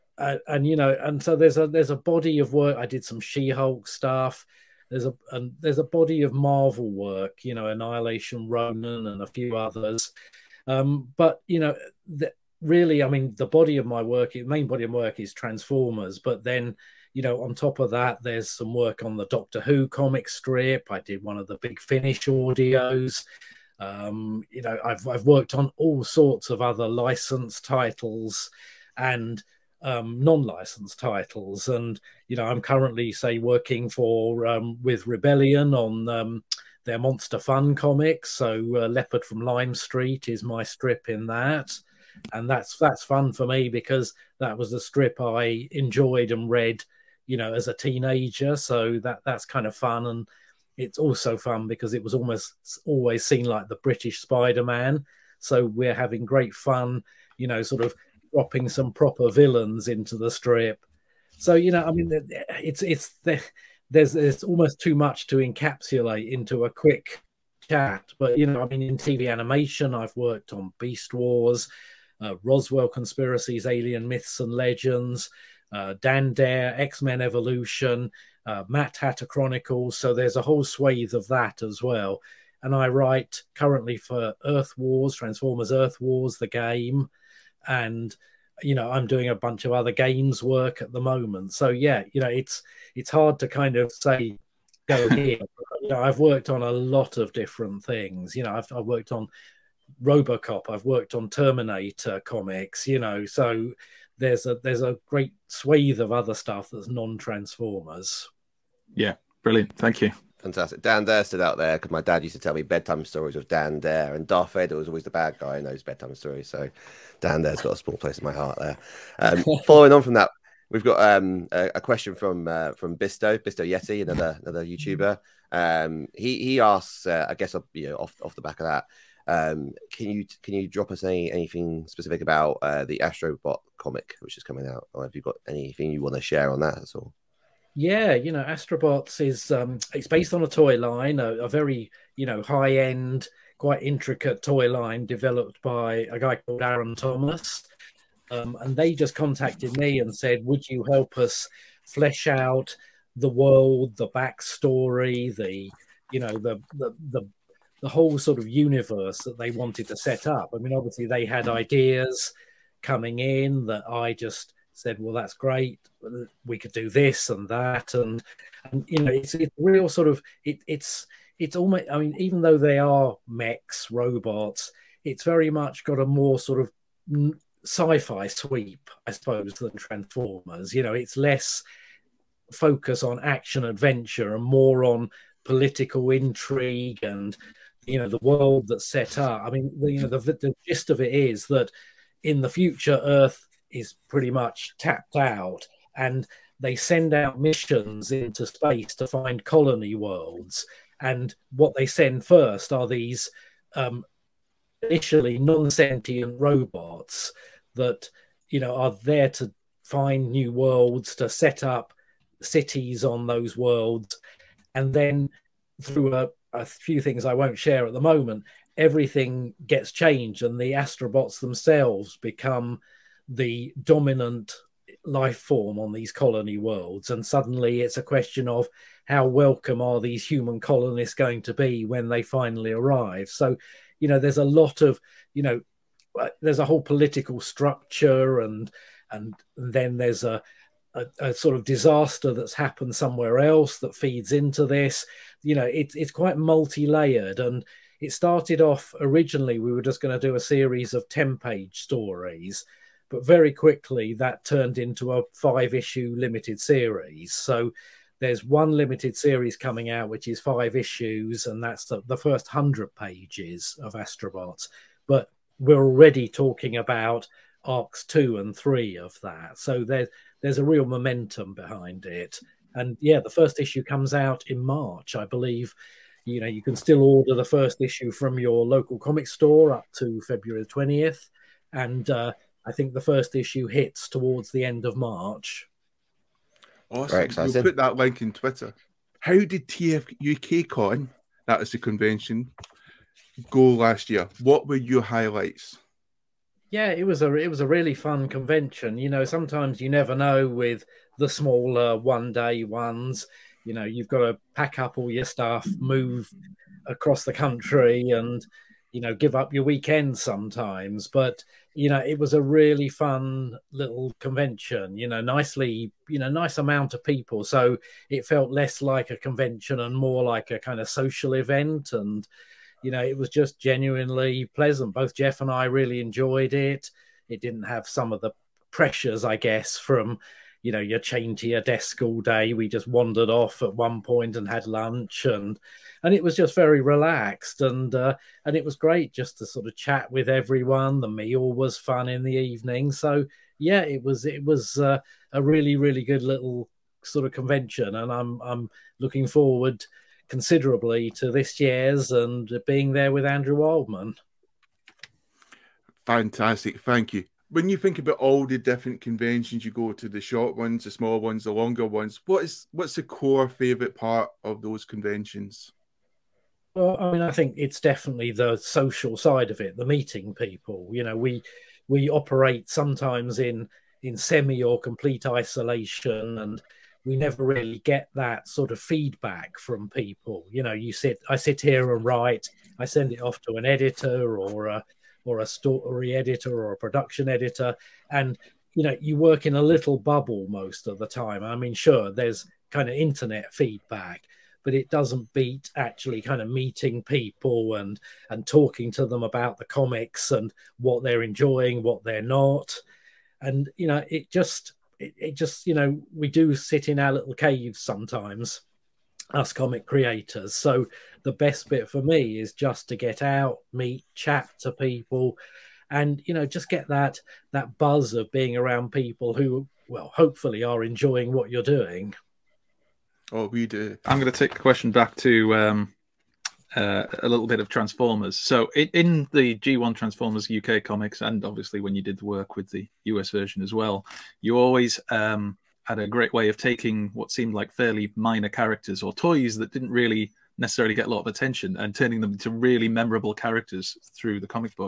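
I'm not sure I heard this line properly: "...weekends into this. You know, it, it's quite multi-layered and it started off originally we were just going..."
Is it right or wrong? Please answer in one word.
wrong.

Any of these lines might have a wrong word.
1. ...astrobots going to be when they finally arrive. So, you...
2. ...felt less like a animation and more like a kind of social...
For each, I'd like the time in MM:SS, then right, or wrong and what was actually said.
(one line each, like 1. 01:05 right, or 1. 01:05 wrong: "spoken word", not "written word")
1. 03:50 wrong: "colonists", not "astrobots"
2. 05:18 wrong: "convention", not "animation".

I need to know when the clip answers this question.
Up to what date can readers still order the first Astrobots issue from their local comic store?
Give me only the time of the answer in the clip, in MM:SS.
04:40.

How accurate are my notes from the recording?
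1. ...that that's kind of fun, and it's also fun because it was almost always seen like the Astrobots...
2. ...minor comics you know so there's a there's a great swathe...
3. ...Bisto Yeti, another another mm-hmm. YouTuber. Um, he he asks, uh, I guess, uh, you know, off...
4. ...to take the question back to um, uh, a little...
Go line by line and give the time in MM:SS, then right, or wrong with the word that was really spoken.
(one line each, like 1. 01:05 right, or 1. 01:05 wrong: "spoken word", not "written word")
1. 00:49 wrong: "British", not "Astrobots"
2. 01:41 wrong: "terminator", not "minor"
3. 02:03 right
4. 07:04 right.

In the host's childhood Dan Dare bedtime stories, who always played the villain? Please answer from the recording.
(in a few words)
Darth Vader.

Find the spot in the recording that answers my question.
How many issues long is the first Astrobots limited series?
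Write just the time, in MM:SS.
04:15.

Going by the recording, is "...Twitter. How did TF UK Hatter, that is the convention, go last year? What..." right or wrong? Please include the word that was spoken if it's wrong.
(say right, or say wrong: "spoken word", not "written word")
wrong: "Con", not "Hatter".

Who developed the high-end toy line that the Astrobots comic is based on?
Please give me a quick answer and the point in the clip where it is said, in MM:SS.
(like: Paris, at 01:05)
Aaron Thomas, at 02:26.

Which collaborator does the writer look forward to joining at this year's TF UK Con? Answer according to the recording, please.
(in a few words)
Andrew Wildman.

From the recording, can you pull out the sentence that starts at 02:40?
I mean, obviously they had ideas coming in that I just said, "Well, that's great.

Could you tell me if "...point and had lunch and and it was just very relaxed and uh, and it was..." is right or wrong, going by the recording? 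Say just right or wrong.
right.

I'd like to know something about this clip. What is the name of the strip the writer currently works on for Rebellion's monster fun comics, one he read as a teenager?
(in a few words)
Leopard from Lime Street.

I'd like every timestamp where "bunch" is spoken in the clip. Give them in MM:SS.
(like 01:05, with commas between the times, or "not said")
01:29.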